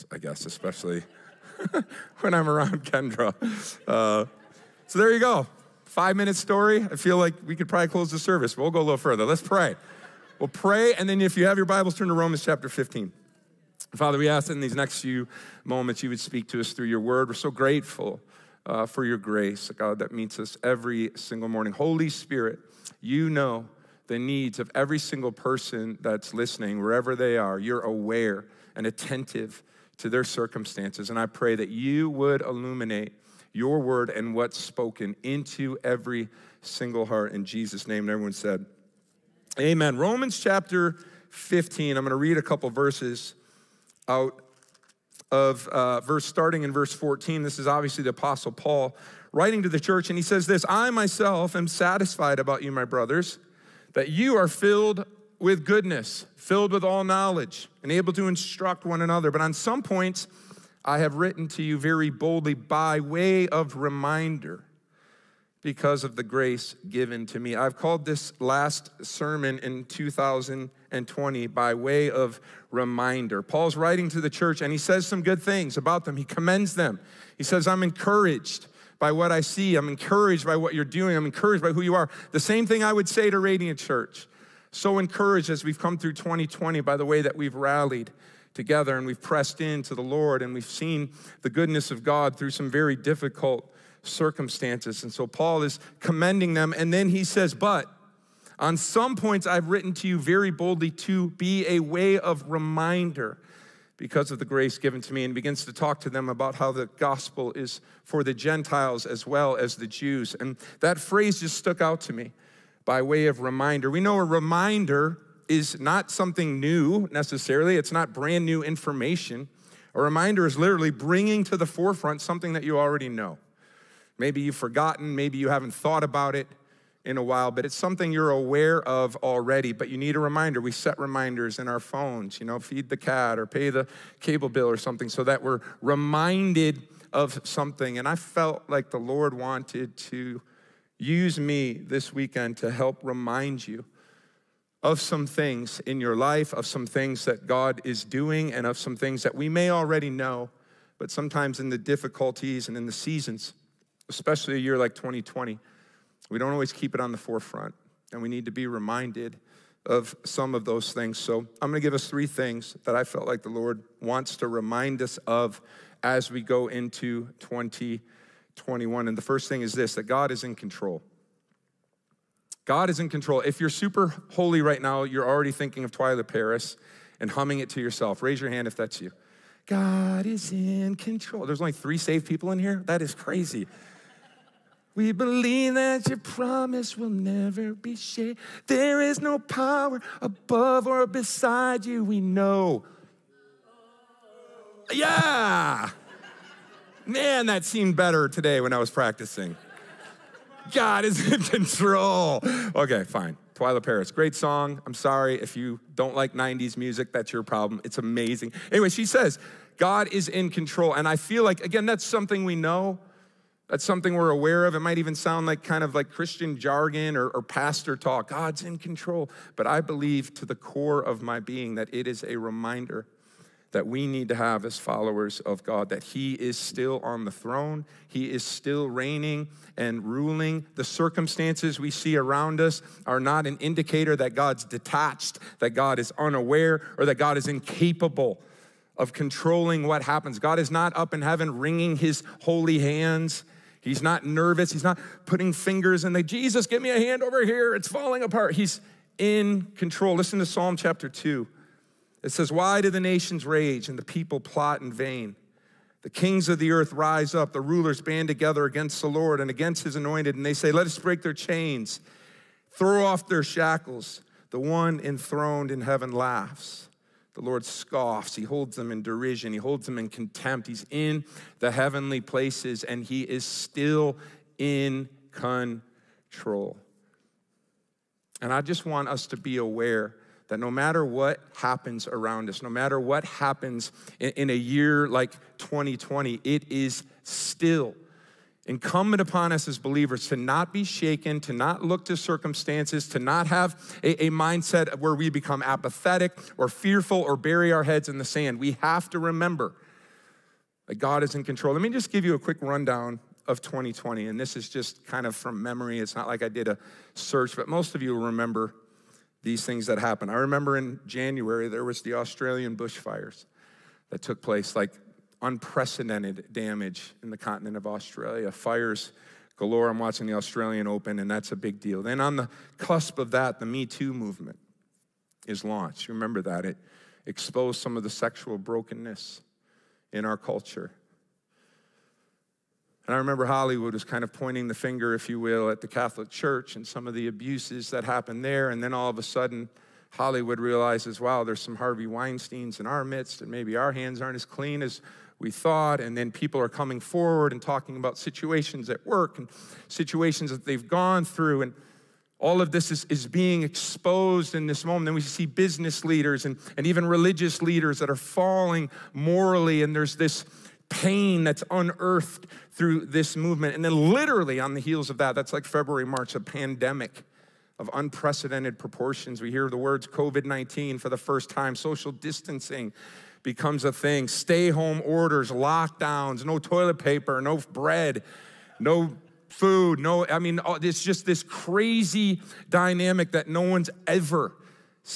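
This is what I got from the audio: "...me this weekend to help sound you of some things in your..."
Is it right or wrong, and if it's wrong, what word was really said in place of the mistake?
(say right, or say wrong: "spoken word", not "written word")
wrong: "remind", not "sound".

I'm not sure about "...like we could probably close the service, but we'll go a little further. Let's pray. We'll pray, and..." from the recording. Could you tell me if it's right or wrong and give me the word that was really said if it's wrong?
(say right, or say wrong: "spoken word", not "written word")
right.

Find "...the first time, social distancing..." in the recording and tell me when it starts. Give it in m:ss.
6:11.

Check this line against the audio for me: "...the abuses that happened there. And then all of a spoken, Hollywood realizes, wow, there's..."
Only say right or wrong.
wrong.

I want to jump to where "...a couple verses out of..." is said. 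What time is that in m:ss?
0:42.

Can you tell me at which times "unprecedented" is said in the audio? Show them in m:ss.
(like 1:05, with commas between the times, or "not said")
5:15, 6:07.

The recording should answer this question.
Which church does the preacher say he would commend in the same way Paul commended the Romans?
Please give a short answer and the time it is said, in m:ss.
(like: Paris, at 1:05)
Radiant Church, at 1:23.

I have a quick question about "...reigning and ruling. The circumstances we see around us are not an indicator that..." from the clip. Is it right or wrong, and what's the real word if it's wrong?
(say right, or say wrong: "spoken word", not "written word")
right.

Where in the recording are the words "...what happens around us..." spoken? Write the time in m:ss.
4:41.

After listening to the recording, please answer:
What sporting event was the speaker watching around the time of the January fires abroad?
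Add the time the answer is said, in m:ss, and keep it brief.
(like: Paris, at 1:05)
Australian Open, at 5:20.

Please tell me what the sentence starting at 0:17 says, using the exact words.
We're so grateful uh, for your grace, God, that meets us every single morning.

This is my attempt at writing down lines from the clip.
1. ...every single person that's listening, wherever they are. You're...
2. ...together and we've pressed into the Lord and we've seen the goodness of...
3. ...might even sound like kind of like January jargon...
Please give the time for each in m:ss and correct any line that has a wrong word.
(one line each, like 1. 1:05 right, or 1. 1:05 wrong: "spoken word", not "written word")
1. 0:24 right
2. 1:28 right
3. 3:34 wrong: "Christian", not "January".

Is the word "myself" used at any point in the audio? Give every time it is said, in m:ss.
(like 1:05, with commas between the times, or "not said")
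0:50.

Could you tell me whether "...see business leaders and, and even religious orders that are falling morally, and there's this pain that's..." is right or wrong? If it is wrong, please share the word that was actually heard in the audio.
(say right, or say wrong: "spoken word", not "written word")
wrong: "leaders", not "orders".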